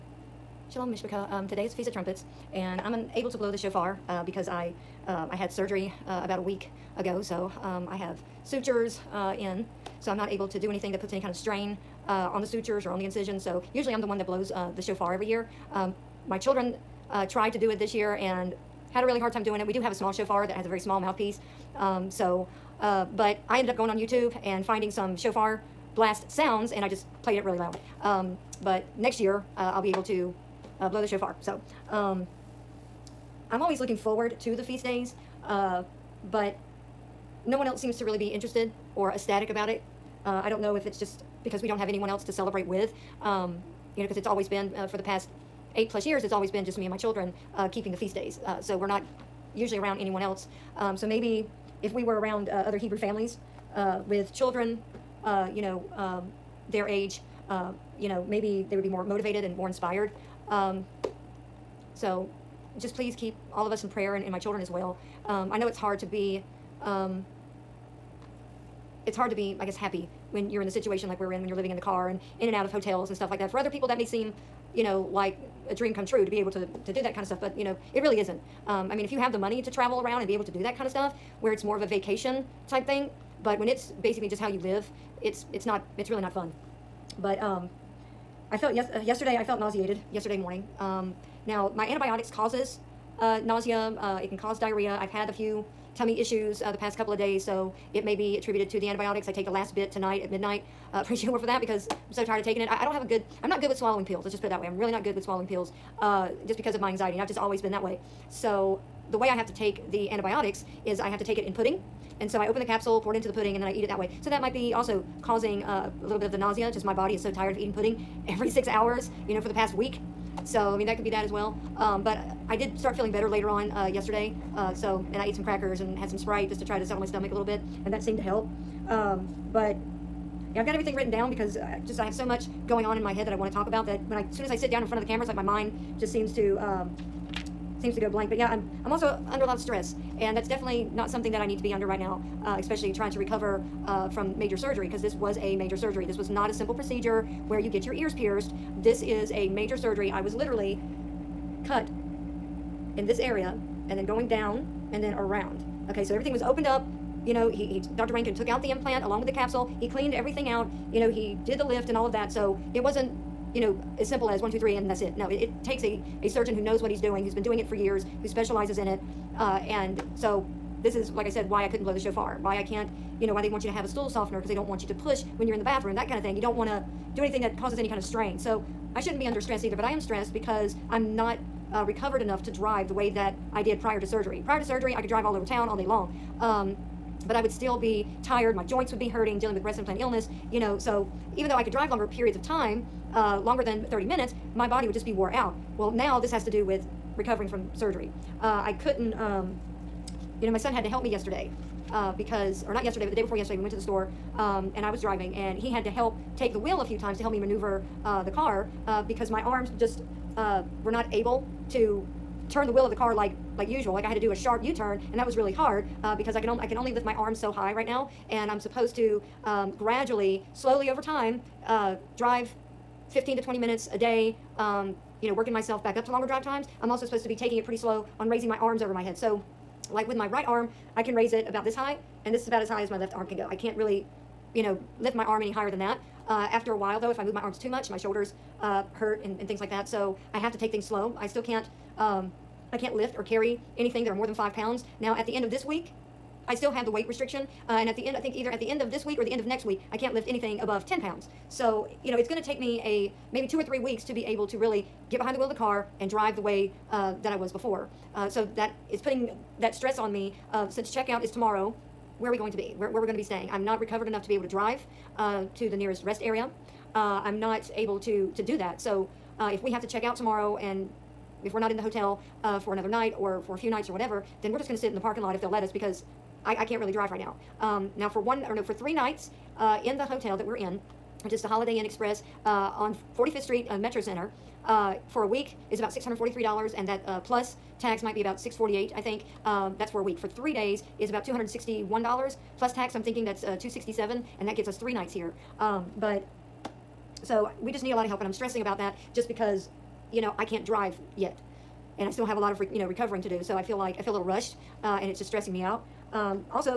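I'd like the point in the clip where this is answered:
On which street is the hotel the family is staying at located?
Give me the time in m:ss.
4:43.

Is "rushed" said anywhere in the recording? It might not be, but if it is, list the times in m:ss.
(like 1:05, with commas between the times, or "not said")
5:04.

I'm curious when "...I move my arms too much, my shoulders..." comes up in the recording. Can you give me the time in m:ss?
3:57.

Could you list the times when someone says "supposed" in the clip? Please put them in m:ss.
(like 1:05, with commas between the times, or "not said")
3:38, 3:47.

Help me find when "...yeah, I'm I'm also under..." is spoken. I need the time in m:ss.
2:18.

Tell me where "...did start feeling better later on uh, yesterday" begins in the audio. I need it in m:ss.
2:02.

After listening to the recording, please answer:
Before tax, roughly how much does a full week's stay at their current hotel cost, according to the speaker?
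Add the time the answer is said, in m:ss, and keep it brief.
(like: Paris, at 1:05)
$643, at 4:45.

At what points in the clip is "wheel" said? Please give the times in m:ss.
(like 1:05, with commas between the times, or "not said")
3:26, 3:32, 4:15.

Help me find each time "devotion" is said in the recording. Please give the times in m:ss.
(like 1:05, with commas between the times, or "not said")
not said.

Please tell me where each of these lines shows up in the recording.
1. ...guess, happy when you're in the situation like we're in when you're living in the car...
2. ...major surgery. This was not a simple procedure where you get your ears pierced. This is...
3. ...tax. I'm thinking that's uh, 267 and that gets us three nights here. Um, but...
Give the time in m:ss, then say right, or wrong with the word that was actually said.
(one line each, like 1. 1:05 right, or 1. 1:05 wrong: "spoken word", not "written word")
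1. 1:09 right
2. 2:25 right
3. 4:52 right.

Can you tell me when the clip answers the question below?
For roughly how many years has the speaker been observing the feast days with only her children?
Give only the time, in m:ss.
0:45.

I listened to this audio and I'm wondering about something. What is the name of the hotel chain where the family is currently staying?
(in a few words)
Holiday Inn Express.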